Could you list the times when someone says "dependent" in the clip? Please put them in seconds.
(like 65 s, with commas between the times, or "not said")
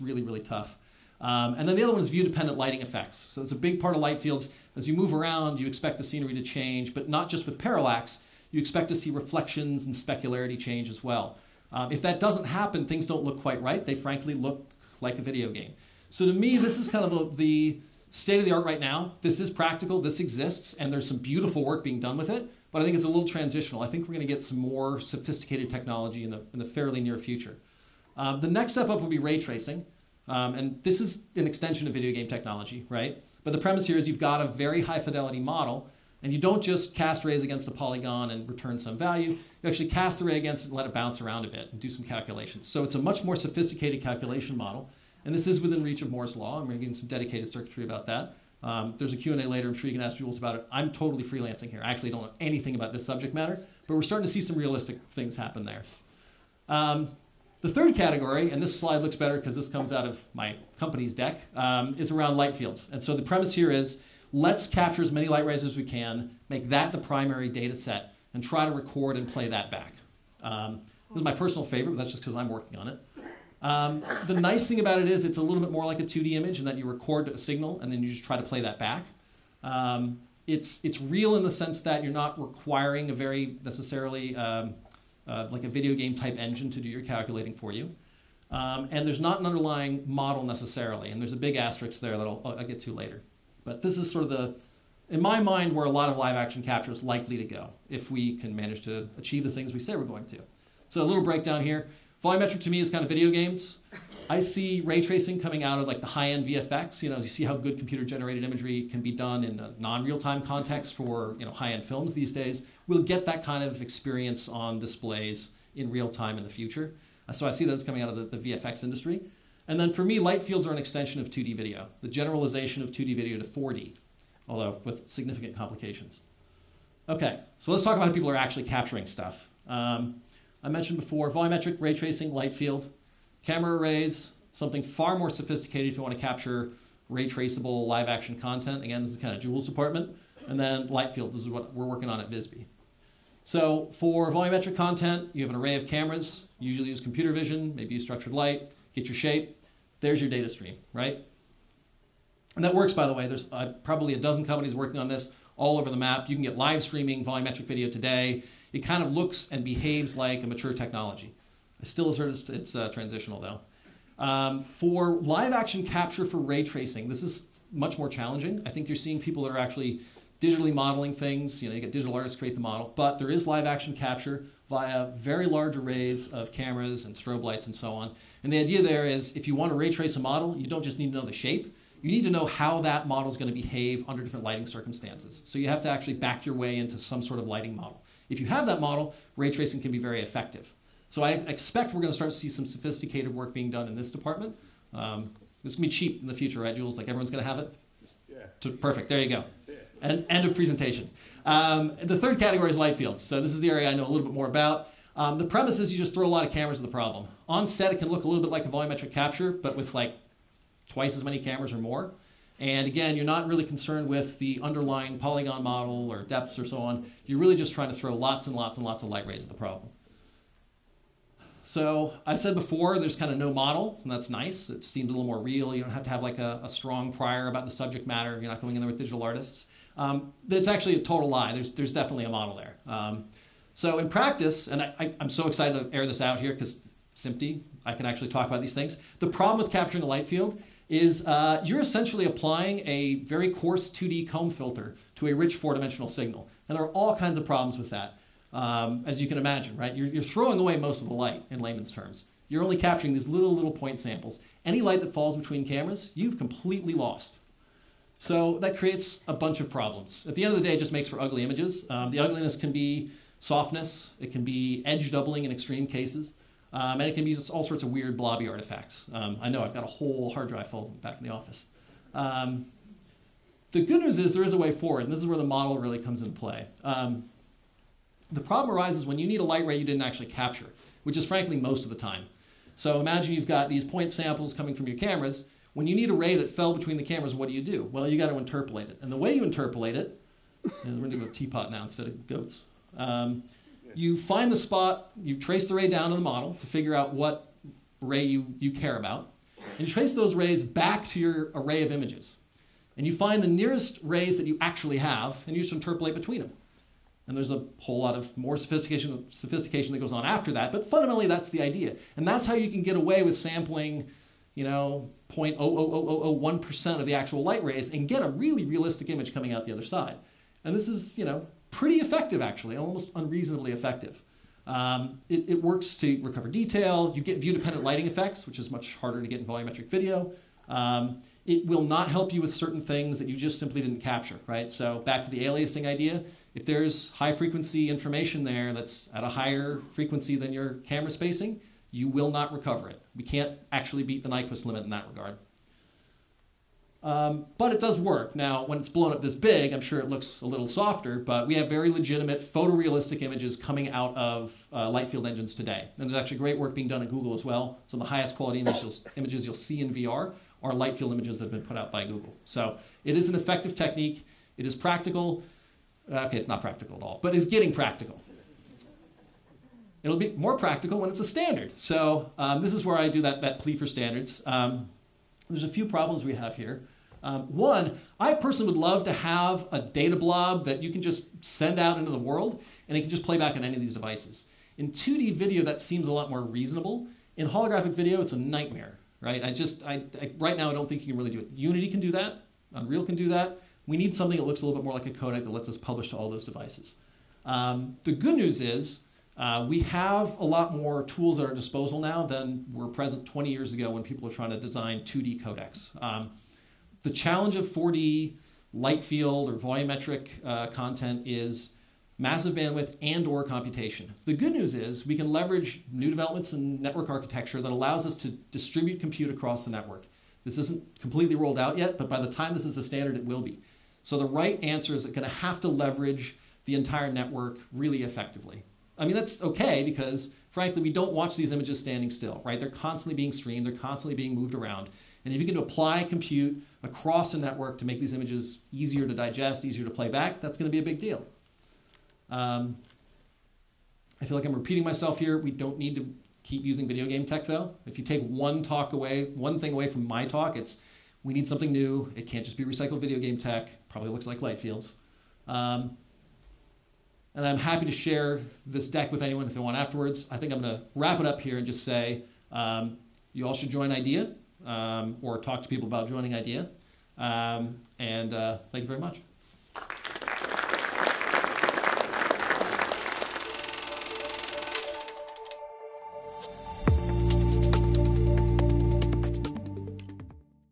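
2 s, 327 s.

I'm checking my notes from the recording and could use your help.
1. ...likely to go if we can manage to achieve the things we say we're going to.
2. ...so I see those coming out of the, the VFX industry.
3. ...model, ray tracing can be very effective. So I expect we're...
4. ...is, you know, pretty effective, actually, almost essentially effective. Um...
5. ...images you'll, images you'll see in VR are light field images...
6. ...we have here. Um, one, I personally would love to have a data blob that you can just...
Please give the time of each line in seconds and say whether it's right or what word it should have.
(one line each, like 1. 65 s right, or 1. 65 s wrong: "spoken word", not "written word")
1. 97 s right
2. 117 s right
3. 188 s right
4. 320 s wrong: "unreasonably", not "essentially"
5. 358 s right
6. 376 s right.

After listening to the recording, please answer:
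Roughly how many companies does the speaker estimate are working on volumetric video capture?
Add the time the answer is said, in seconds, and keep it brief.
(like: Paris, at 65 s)
A dozen, at 154 s.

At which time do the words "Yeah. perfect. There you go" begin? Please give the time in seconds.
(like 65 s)
198 s.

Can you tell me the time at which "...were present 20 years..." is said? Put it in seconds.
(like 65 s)
402 s.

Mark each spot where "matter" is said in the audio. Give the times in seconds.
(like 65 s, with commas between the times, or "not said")
53 s, 228 s.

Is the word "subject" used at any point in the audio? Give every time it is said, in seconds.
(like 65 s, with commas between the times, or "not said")
53 s, 227 s.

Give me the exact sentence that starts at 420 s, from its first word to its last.
This isn't completely rolled out yet, but by the time this is a standard, it will be.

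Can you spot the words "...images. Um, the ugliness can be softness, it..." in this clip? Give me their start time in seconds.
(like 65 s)
261 s.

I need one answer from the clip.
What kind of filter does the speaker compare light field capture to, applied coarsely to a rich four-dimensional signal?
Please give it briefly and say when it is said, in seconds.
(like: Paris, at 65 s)
2D comb filter, at 243 s.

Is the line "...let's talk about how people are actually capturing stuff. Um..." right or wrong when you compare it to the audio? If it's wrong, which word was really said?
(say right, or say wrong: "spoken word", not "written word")
right.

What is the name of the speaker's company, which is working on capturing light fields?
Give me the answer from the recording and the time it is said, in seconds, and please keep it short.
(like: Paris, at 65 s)
Visby, at 142 s.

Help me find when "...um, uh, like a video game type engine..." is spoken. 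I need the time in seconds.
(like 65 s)
84 s.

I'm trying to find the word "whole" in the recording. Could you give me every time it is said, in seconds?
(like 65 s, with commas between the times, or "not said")
269 s, 307 s.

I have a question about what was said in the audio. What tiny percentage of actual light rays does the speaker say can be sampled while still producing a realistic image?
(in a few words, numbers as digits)
0.00001%.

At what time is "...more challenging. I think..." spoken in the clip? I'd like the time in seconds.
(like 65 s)
167 s.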